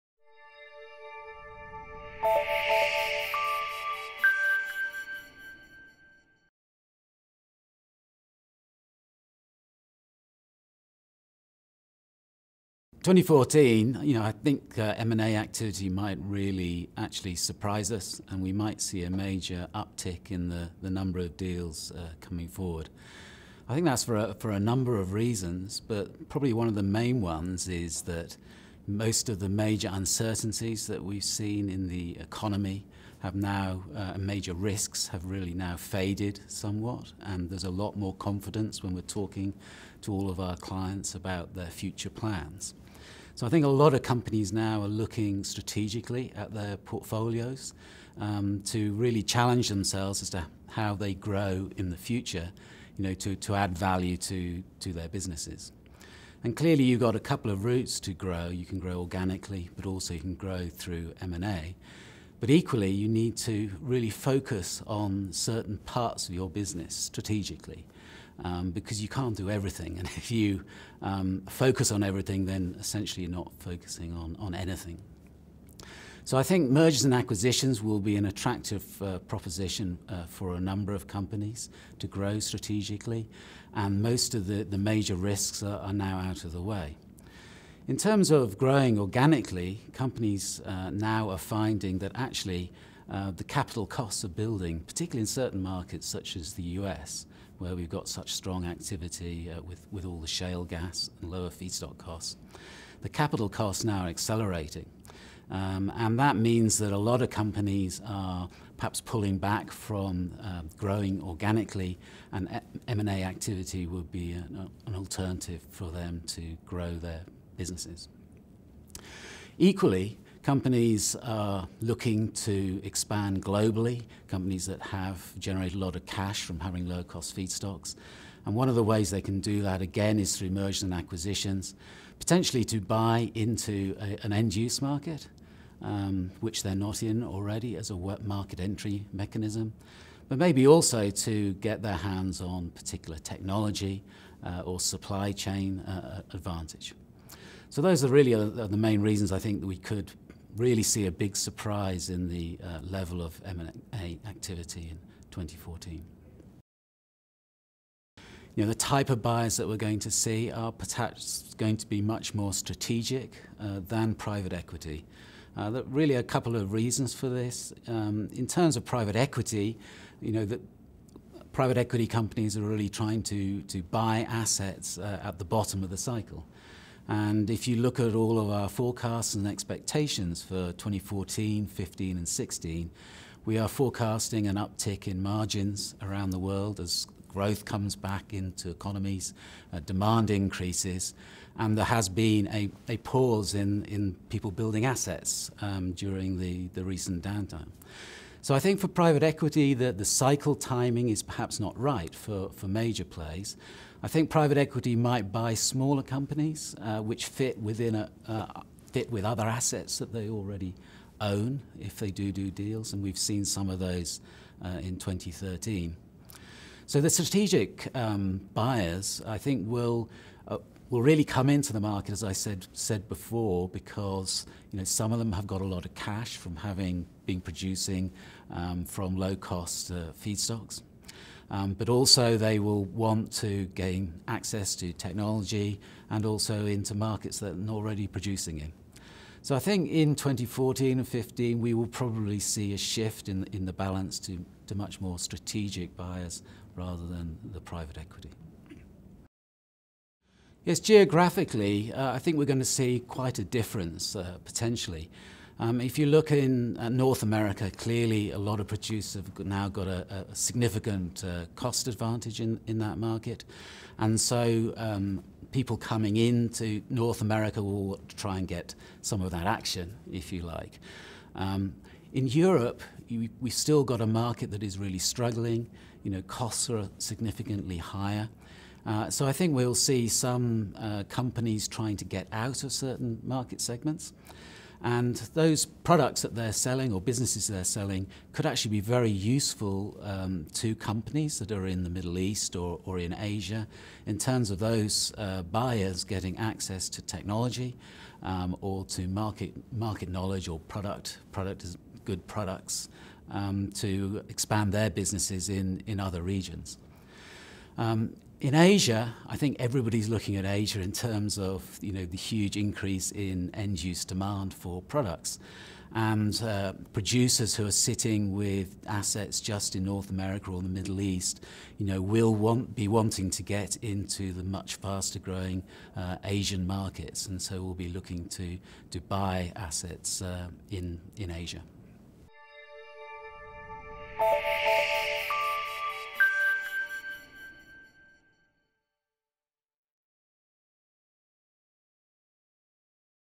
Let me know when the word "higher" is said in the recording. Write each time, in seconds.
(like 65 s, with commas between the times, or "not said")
277 s.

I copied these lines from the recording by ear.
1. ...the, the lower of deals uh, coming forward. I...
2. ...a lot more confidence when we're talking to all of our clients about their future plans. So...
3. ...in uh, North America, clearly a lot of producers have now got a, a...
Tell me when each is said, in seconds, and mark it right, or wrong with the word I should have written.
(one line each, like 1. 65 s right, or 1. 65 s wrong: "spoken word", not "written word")
1. 20 s wrong: "number", not "lower"
2. 37 s right
3. 256 s right.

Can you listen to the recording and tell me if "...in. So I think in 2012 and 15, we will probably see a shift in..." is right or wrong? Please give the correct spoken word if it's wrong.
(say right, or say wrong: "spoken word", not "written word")
wrong: "2014", not "2012".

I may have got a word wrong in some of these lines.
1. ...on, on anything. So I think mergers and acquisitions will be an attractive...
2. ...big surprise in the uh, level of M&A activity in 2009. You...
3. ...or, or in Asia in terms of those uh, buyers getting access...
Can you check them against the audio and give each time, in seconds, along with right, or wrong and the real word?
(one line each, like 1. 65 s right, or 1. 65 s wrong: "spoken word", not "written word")
1. 74 s right
2. 151 s wrong: "2014", not "2009"
3. 292 s right.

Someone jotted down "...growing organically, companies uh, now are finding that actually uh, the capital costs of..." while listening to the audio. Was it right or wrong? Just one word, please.
right.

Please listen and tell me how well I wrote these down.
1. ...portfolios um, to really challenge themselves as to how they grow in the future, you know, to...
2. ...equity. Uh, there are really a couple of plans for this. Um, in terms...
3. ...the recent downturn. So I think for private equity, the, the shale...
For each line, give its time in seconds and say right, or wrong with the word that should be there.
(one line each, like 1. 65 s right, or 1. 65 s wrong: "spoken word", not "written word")
1. 46 s right
2. 164 s wrong: "reasons", not "plans"
3. 196 s wrong: "cycle", not "shale".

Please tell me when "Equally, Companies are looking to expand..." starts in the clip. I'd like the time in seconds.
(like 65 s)
119 s.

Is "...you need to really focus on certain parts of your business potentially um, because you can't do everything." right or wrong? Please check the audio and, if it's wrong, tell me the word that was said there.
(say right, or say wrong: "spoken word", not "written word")
wrong: "strategically", not "potentially".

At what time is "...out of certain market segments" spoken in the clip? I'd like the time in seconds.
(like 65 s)
282 s.